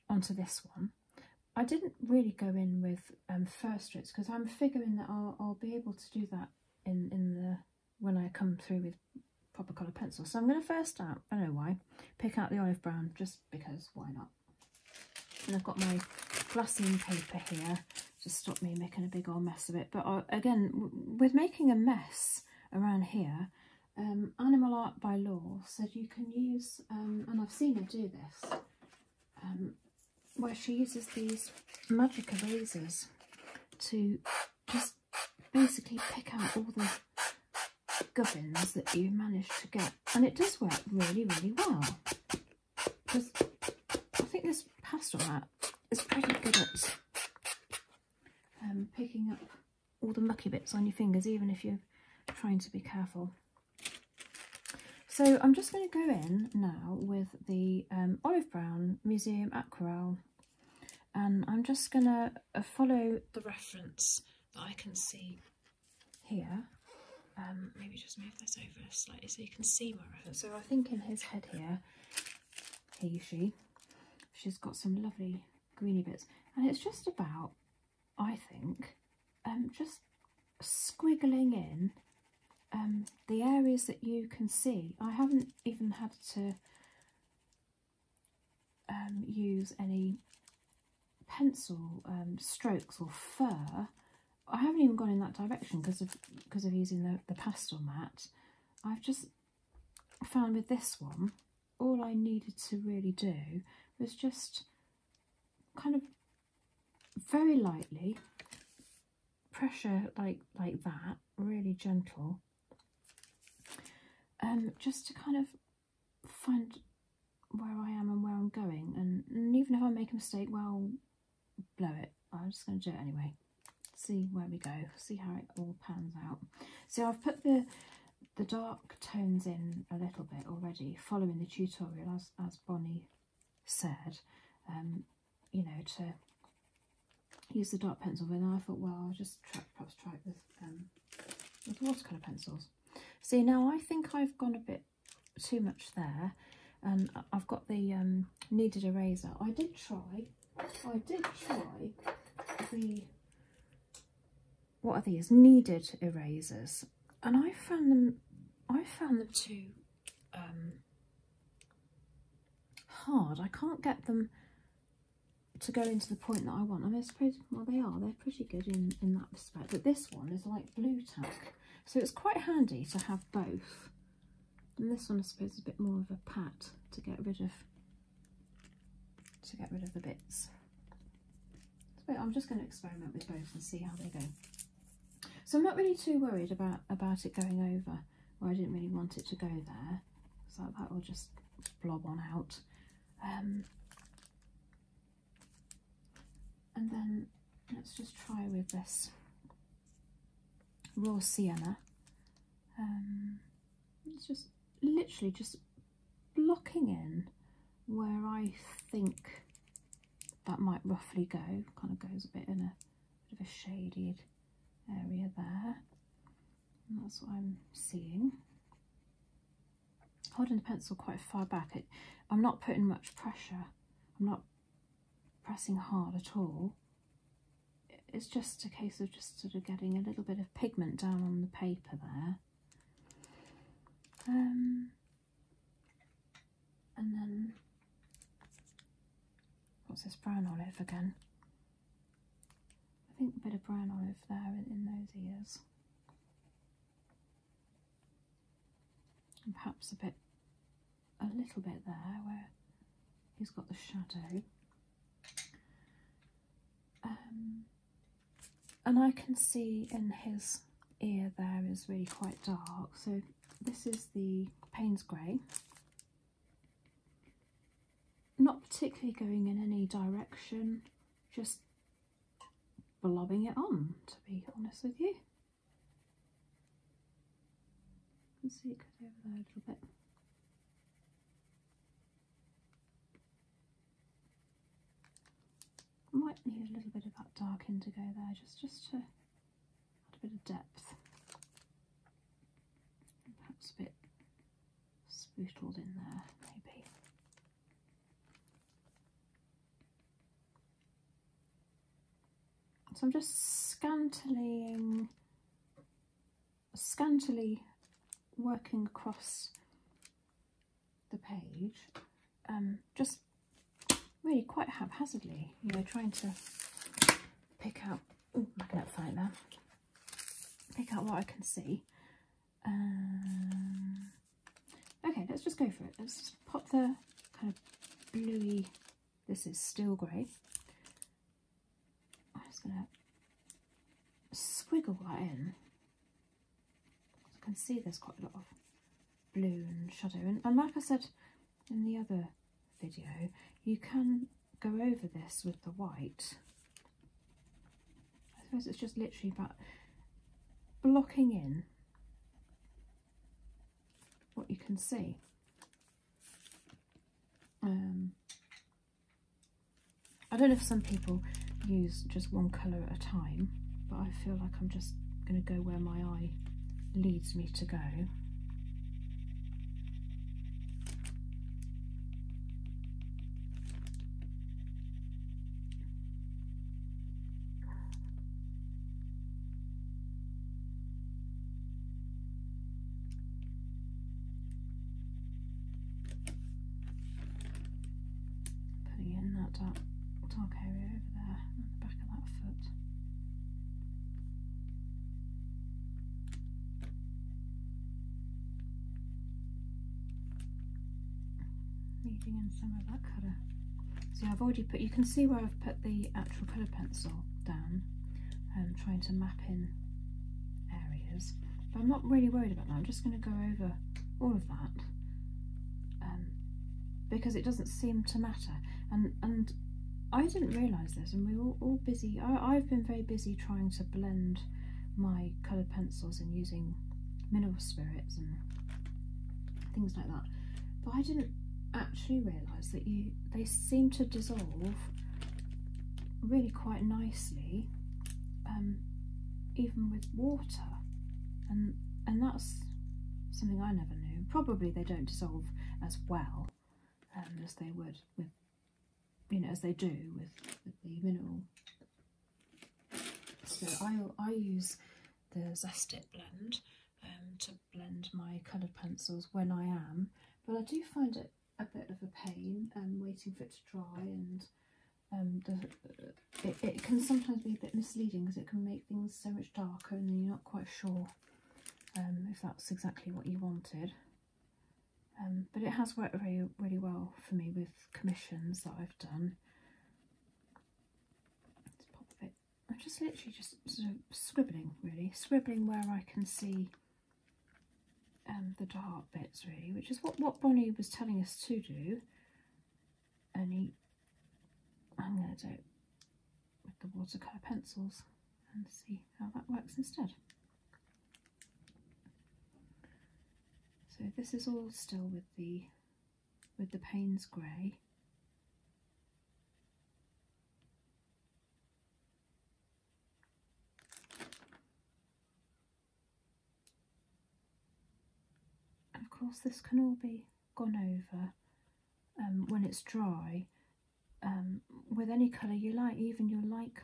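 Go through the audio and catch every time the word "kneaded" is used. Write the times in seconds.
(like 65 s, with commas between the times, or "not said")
148 s, 155 s.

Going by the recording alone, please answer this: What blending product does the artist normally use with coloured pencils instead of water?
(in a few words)
Zest-it.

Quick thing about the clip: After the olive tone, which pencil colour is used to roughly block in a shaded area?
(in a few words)
raw sienna.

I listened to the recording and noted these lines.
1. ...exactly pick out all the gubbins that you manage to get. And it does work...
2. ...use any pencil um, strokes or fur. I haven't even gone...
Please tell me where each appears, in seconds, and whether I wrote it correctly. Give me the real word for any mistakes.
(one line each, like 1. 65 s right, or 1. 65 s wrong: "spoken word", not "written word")
1. 35 s wrong: "basically", not "exactly"
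2. 89 s right.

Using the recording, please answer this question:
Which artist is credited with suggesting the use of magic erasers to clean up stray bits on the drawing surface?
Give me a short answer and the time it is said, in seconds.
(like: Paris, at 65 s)
Animal Art by Law, at 24 s.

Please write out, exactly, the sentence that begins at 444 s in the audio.
Probably they don't dissolve as well um, as they would with you know, as they do with, with the mineral.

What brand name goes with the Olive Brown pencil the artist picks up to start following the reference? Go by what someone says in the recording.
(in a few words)
Museum Aquarelle.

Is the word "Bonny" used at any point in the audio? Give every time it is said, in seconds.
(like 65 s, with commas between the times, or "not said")
132 s, 490 s.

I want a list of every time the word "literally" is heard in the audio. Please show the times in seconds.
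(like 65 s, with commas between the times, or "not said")
204 s, 348 s, 483 s.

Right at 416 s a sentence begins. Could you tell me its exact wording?
Um, because it doesn't seem to matter and and I didn't realise this, and we were all, busy.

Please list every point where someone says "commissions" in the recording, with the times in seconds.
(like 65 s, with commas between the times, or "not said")
477 s.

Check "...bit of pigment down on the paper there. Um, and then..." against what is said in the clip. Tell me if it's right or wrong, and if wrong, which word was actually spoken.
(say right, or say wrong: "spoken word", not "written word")
right.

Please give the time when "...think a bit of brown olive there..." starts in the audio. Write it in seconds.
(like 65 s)
243 s.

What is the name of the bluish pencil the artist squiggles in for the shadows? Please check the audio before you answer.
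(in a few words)
steel grey.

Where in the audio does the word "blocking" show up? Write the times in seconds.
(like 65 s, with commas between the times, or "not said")
206 s, 350 s.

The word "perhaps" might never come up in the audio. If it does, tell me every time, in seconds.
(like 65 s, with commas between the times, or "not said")
139 s, 249 s, 293 s.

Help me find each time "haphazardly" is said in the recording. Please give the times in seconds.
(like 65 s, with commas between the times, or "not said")
314 s.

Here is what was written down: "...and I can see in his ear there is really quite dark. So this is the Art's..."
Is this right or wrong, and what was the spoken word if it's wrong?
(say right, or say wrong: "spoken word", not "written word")
wrong: "Payne", not "Art".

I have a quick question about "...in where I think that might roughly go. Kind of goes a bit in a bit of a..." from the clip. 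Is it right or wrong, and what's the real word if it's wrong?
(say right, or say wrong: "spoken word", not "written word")
right.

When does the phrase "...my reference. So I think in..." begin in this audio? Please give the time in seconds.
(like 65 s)
69 s.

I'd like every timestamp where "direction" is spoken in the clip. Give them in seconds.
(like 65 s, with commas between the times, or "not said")
95 s, 269 s.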